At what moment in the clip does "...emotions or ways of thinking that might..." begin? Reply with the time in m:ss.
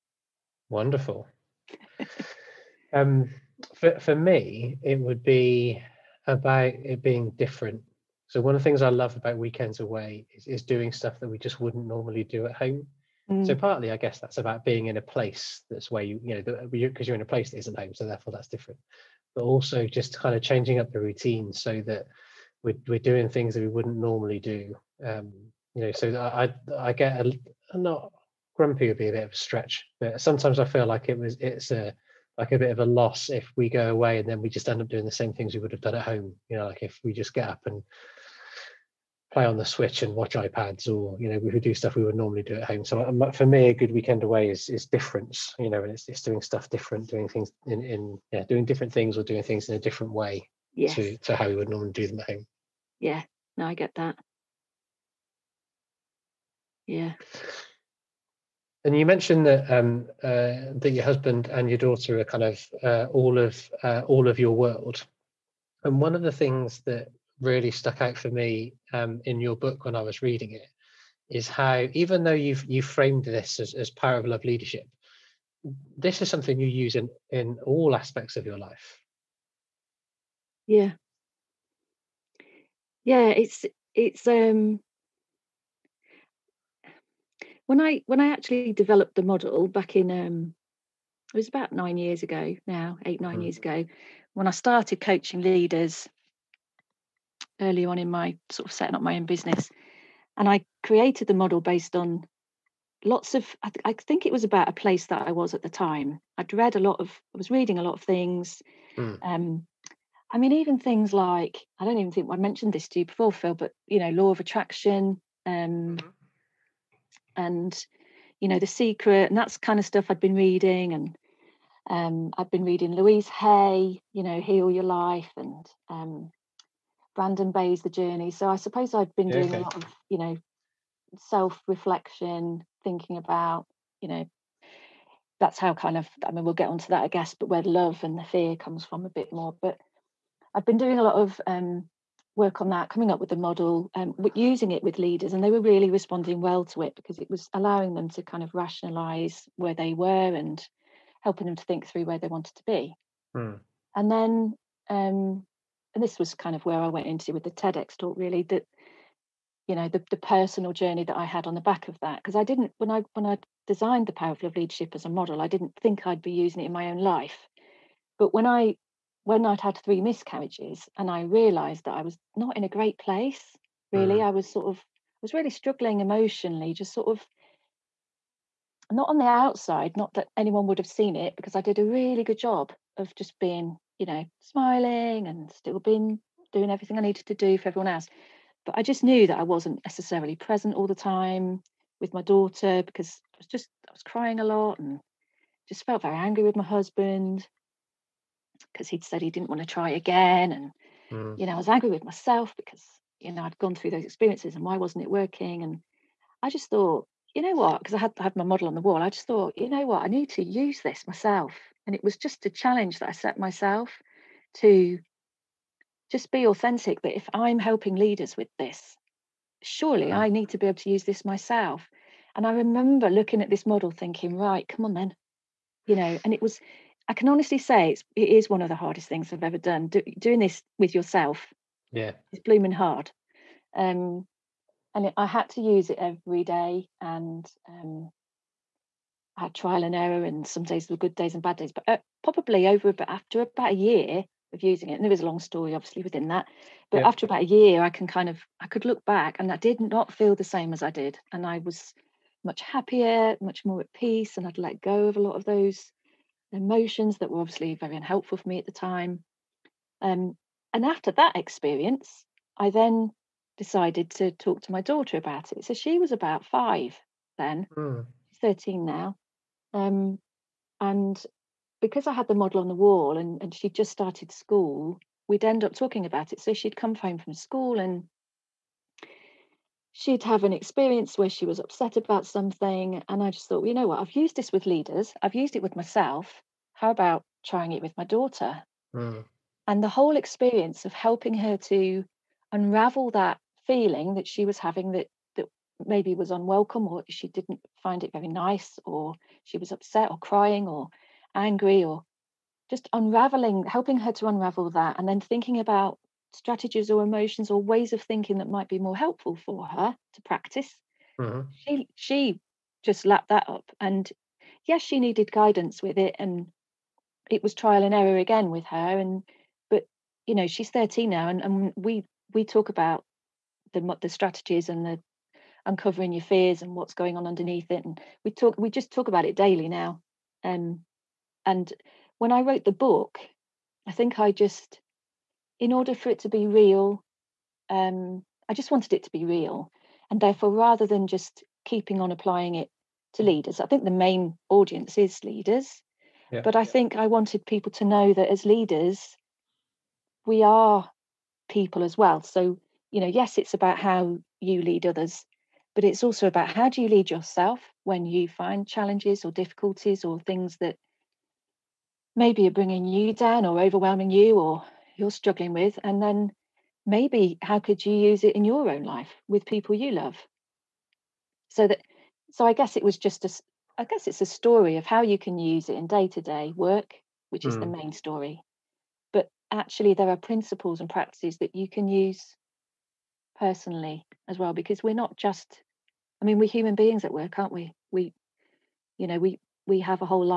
5:07.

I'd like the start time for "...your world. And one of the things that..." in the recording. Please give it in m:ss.
1:04.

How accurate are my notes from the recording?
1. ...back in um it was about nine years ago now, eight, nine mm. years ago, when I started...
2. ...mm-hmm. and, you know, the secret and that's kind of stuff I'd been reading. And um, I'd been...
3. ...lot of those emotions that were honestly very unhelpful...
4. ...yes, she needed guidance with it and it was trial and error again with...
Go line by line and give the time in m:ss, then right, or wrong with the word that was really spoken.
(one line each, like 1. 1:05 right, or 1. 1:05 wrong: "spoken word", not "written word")
1. 1:29 right
2. 1:55 right
3. 4:15 wrong: "obviously", not "honestly"
4. 5:14 right.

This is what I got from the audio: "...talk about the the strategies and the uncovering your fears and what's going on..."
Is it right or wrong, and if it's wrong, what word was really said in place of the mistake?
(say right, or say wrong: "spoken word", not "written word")
right.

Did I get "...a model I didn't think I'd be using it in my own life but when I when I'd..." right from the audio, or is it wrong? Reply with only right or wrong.
right.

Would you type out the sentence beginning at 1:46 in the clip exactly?
I'd read a lot of, I was reading a lot of things.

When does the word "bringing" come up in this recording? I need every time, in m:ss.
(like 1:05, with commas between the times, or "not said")
6:02.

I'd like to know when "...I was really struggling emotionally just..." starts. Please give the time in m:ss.
2:54.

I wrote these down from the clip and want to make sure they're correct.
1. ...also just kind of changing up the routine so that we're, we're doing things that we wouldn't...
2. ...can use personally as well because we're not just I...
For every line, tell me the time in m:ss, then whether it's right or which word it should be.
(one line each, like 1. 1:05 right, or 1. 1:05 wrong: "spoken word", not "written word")
1. 0:19 right
2. 6:21 right.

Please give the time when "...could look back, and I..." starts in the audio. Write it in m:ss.
4:08.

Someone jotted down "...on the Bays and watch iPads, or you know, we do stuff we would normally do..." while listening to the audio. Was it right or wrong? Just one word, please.
wrong.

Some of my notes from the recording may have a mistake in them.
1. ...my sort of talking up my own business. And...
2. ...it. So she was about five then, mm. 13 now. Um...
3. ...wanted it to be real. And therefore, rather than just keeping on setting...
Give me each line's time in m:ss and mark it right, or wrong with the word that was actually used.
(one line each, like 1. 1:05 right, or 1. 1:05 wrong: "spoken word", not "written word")
1. 1:38 wrong: "setting", not "talking"
2. 4:25 right
3. 5:38 wrong: "applying", not "setting".